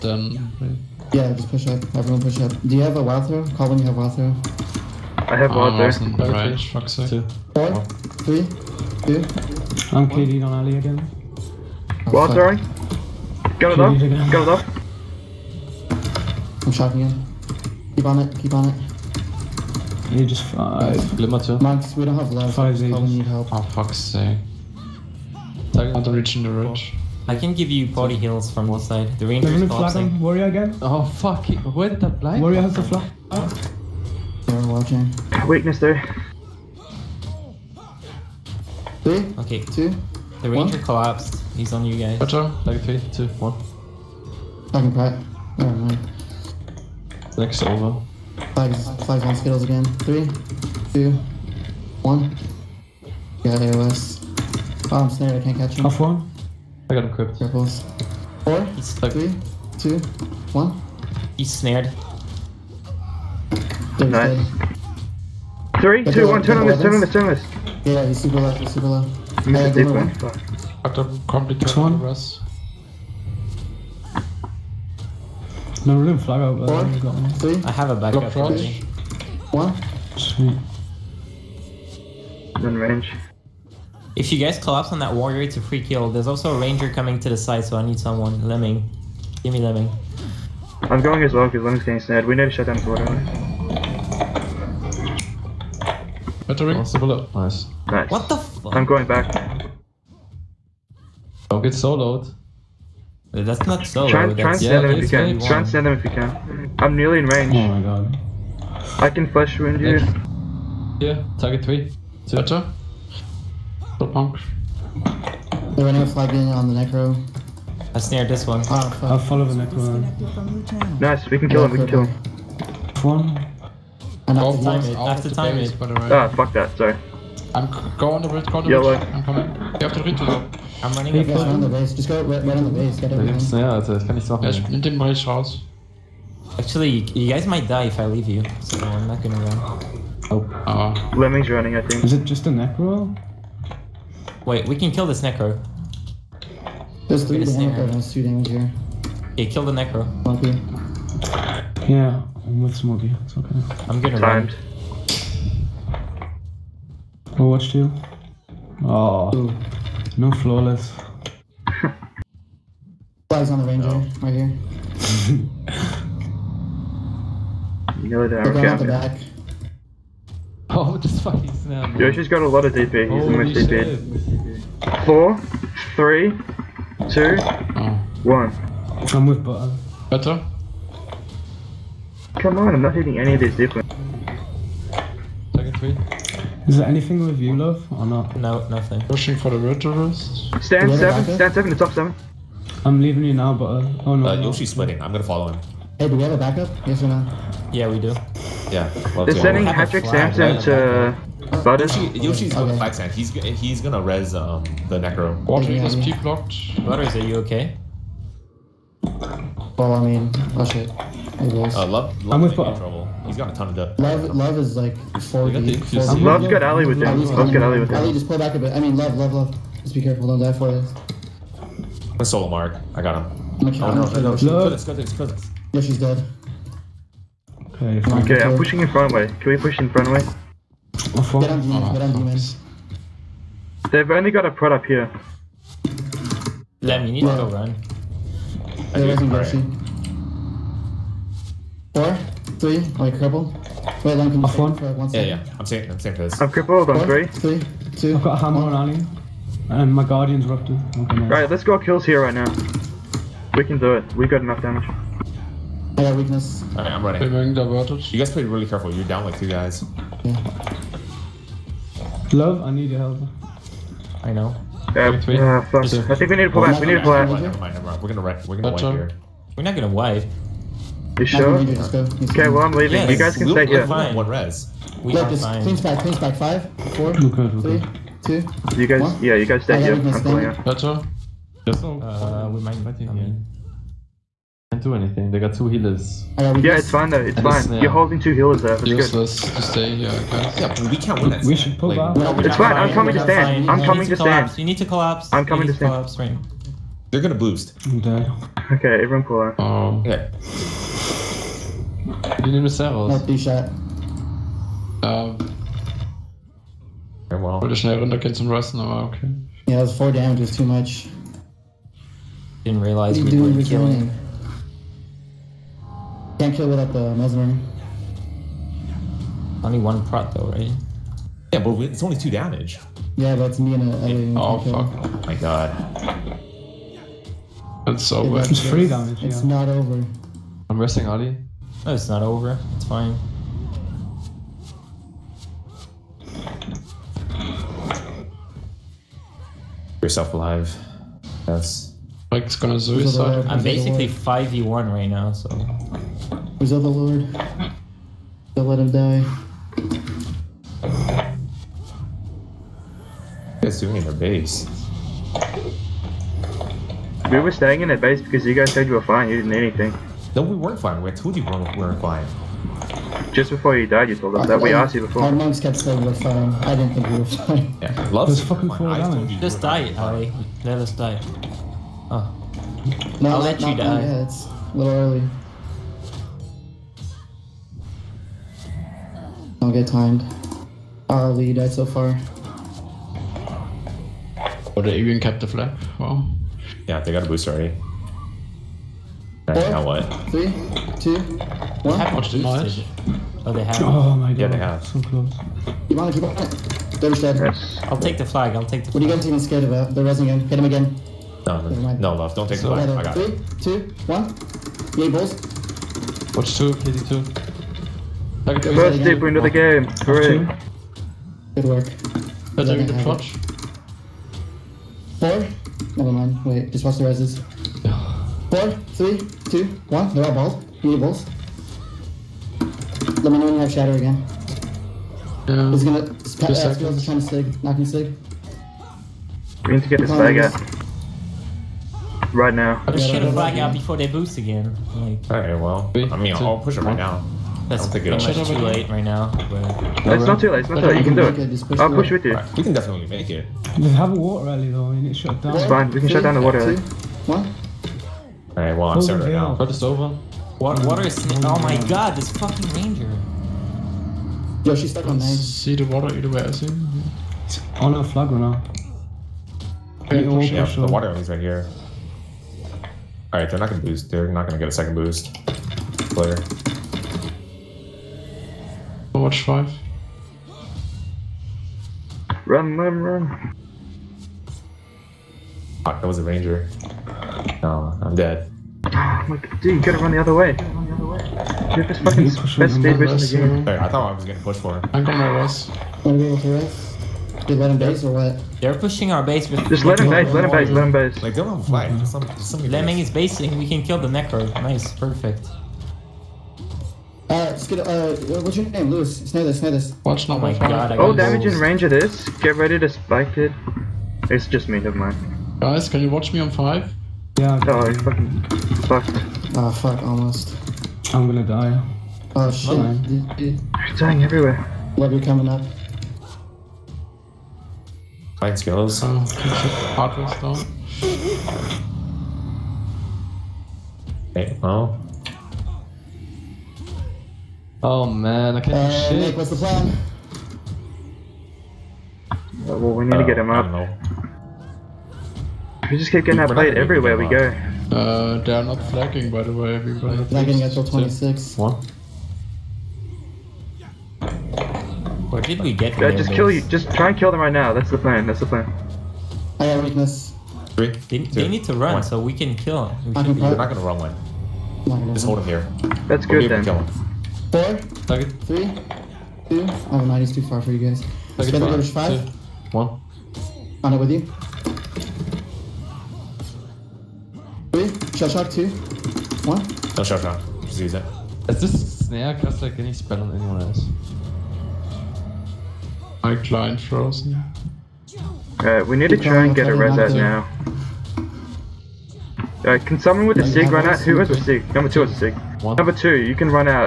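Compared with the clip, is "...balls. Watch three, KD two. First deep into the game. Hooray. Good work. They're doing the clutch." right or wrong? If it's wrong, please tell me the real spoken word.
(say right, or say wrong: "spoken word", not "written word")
wrong: "two", not "three".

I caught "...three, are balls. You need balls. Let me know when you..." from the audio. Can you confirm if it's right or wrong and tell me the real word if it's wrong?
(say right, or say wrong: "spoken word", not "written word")
wrong: "two", not "three".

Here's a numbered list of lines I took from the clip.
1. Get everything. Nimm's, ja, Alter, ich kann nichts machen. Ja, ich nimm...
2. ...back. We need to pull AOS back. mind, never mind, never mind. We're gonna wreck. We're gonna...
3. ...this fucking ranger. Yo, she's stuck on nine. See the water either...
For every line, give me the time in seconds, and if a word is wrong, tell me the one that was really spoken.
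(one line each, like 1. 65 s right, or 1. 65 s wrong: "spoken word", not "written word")
1. 132 s right
2. 266 s wrong: "Never", not "AOS"
3. 452 s right.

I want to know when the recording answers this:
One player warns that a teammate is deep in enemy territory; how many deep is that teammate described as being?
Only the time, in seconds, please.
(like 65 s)
215 s.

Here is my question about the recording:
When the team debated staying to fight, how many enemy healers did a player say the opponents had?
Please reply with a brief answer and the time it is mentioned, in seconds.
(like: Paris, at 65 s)
2, at 285 s.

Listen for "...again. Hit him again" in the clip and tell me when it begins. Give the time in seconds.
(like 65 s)
400 s.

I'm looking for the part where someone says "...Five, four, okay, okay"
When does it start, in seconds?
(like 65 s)
276 s.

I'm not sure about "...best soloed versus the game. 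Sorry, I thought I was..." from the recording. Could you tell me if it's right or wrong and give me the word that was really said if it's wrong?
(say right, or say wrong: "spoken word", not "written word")
wrong: "speed", not "soloed".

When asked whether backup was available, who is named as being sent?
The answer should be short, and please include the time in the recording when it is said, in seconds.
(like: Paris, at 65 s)
Patrick Sampson, at 199 s.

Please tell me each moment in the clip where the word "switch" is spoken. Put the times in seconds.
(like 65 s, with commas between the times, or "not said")
not said.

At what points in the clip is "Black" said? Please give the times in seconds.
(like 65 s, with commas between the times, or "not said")
202 s.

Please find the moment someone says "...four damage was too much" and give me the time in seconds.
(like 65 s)
309 s.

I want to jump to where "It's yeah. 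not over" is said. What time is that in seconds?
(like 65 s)
329 s.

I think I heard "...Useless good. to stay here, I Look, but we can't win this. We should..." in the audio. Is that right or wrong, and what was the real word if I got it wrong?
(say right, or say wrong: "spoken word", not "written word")
wrong: "Yeah", not "Look".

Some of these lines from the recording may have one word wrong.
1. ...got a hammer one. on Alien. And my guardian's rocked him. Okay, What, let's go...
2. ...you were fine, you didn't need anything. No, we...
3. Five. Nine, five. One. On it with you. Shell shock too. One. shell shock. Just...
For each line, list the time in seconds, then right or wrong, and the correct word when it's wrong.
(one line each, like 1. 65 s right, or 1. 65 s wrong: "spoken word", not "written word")
1. 248 s wrong: "Right", not "What"
2. 358 s right
3. 561 s wrong: "Two", not "Nine".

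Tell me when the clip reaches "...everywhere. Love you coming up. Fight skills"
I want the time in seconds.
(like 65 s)
514 s.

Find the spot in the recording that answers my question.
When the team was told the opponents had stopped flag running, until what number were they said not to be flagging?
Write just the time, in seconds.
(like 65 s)
540 s.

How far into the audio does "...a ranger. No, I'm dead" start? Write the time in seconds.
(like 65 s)
476 s.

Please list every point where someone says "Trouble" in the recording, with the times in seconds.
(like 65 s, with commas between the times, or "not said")
212 s.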